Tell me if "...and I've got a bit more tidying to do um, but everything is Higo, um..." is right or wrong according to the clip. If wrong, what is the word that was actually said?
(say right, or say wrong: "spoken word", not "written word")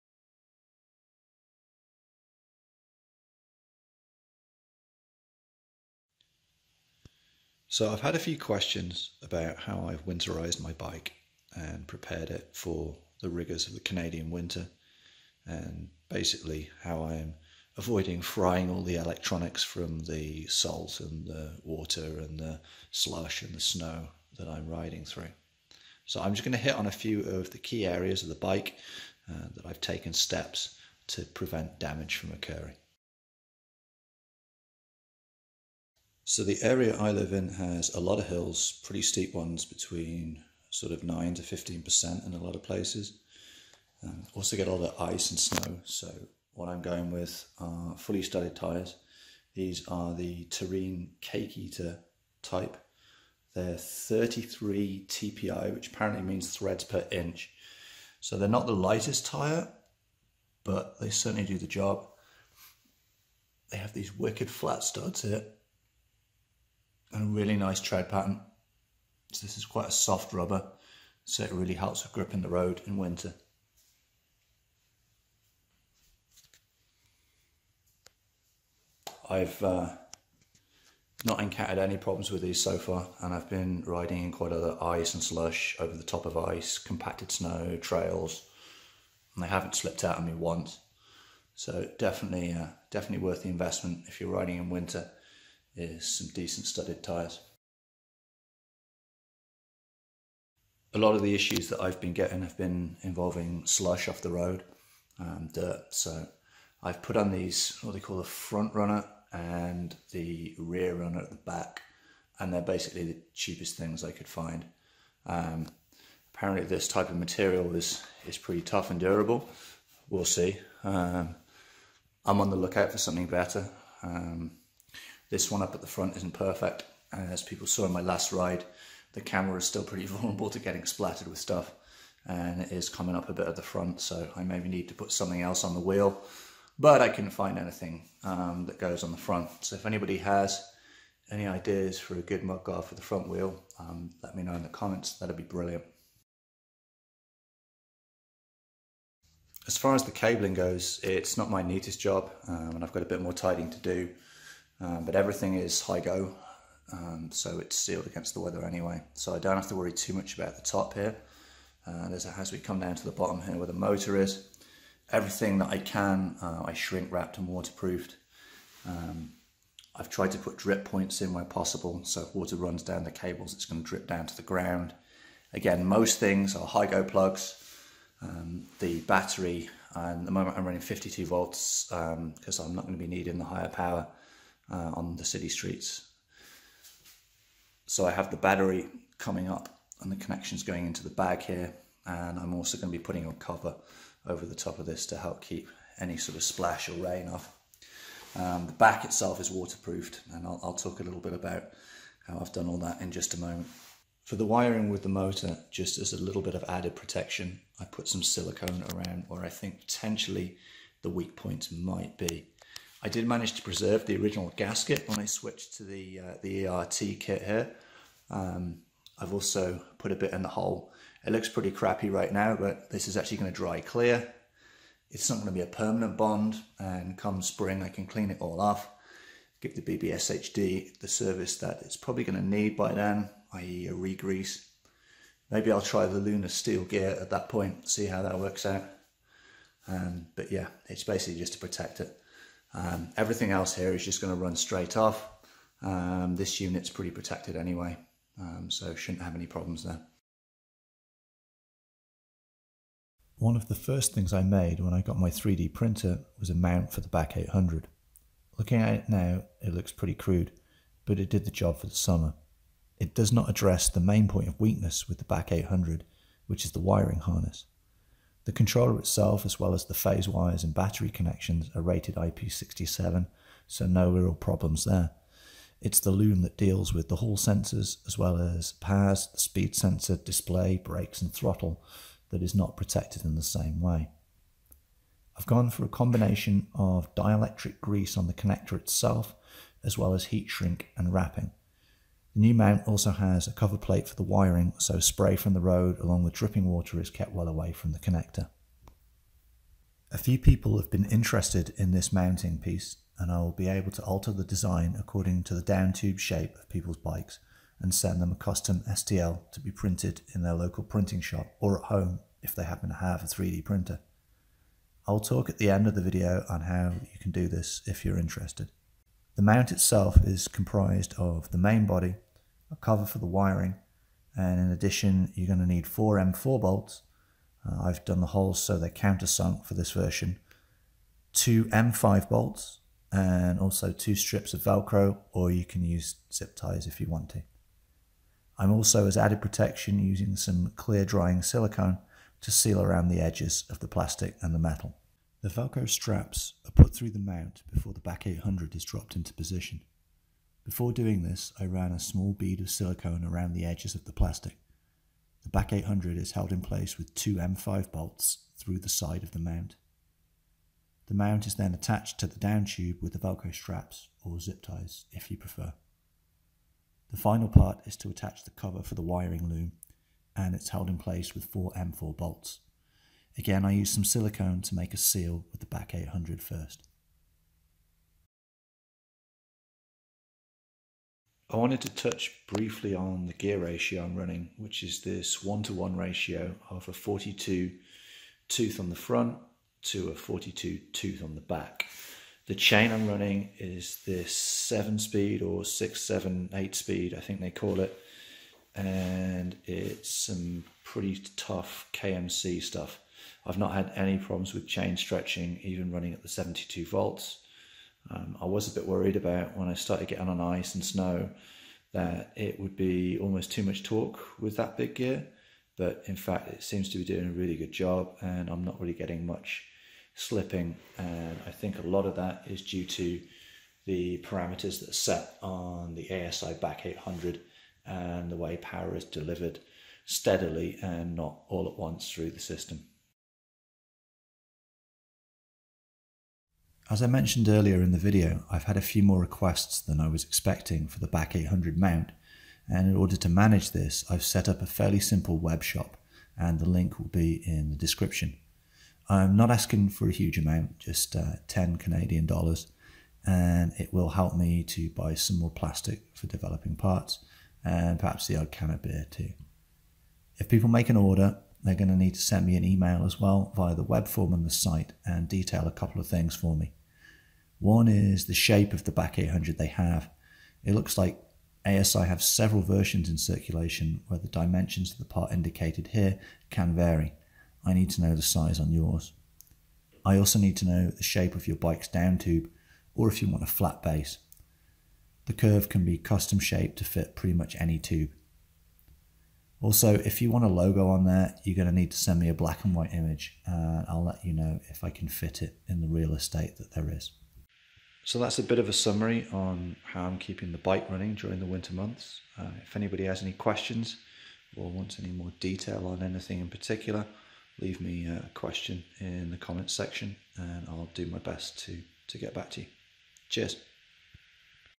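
right.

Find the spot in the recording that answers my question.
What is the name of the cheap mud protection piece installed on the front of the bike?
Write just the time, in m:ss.
1:48.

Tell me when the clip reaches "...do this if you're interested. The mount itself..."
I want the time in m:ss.
5:17.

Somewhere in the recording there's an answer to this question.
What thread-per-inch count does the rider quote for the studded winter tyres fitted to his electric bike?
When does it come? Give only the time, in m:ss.
0:53.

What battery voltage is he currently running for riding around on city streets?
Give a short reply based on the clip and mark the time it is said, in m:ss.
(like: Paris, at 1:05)
52 volts, at 3:00.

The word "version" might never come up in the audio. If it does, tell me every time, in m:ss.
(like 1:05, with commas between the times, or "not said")
5:29, 7:52.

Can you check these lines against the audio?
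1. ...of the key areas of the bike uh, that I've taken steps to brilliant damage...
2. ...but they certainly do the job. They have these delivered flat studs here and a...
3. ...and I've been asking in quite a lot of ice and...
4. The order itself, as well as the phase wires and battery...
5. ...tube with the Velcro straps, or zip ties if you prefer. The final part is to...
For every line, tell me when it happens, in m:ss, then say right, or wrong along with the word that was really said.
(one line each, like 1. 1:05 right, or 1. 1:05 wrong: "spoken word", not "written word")
1. 0:27 wrong: "prevent", not "brilliant"
2. 1:00 wrong: "wicked", not "delivered"
3. 1:23 wrong: "riding", not "asking"
4. 4:28 wrong: "controller", not "order"
5. 6:02 right.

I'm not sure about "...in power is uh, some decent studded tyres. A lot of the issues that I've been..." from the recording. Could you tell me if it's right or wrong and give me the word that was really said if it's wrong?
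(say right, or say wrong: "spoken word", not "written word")
wrong: "winter", not "power".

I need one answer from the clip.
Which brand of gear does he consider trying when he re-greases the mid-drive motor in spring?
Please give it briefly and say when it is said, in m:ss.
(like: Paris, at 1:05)
Luna, at 3:56.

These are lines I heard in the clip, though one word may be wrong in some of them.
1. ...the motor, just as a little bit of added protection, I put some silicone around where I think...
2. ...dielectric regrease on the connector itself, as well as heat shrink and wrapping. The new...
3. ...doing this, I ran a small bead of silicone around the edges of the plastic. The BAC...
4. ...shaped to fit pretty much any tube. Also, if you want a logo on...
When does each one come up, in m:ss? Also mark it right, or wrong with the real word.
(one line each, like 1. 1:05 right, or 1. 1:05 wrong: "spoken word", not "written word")
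1. 3:25 right
2. 4:47 wrong: "grease", not "regrease"
3. 5:50 right
4. 8:06 right.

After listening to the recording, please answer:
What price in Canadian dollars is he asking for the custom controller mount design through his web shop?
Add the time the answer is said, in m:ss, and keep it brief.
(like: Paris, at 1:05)
10 Canadian dollars, at 7:31.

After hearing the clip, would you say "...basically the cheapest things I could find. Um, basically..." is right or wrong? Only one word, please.
wrong.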